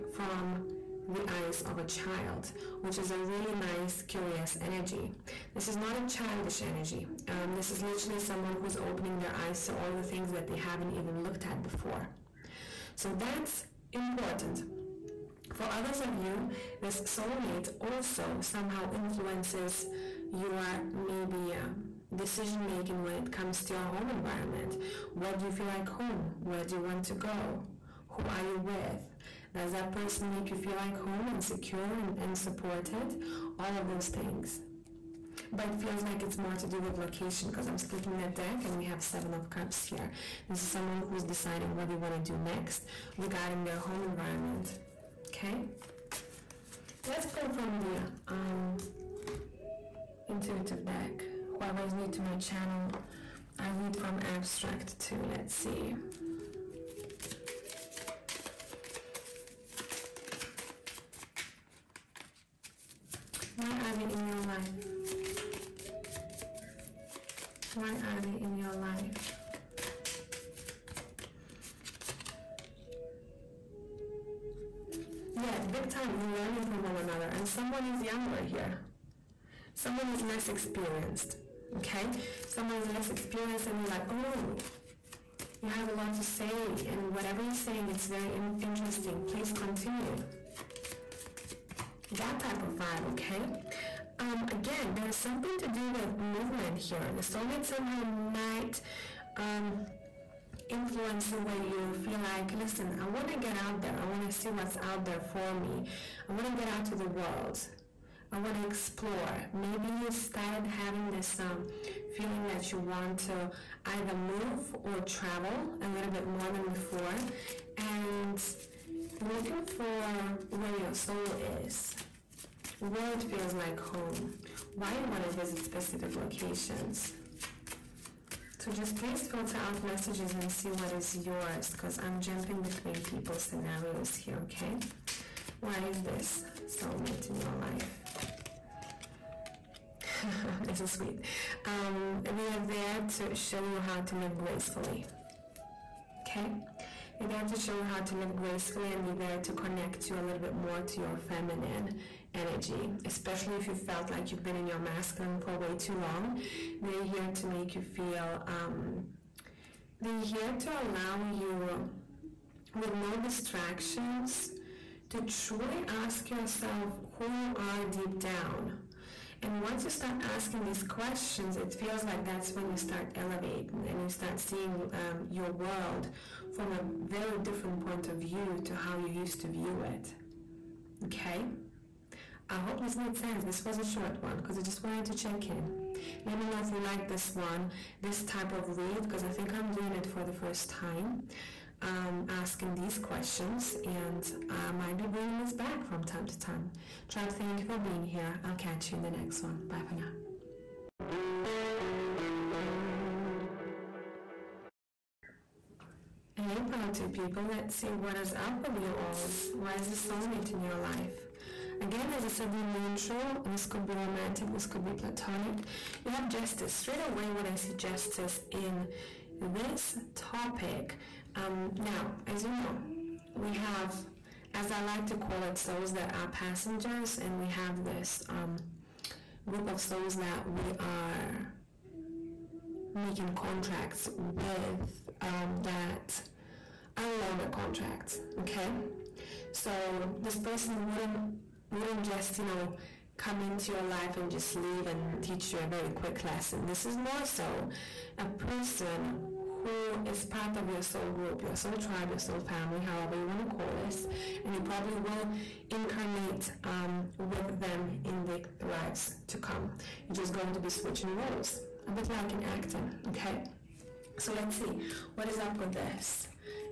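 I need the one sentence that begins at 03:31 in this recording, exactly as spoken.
Again, as I said in the intro, this could be romantic, this could be platonic.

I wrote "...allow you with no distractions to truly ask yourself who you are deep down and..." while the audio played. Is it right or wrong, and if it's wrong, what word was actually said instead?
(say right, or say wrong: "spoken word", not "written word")
right.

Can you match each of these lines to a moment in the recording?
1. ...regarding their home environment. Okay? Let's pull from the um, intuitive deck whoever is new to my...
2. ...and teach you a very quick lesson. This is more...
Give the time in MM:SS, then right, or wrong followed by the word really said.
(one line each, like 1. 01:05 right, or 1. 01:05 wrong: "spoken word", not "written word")
1. 00:43 right
2. 04:04 right.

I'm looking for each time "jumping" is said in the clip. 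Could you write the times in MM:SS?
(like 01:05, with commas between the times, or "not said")
02:12.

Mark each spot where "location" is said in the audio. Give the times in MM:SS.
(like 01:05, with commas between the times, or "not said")
00:36, 02:06.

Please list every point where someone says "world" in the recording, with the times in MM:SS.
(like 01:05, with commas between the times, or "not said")
01:47, 02:55.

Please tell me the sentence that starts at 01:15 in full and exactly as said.
Yeah, big time, you're learning from one another, and someone is younger here.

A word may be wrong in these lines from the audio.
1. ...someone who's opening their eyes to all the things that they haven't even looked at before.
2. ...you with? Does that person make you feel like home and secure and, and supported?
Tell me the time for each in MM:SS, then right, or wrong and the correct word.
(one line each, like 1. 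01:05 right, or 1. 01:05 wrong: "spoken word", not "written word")
1. 00:08 right
2. 00:28 right.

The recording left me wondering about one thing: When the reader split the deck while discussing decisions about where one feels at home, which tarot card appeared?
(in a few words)
Seven of Cups.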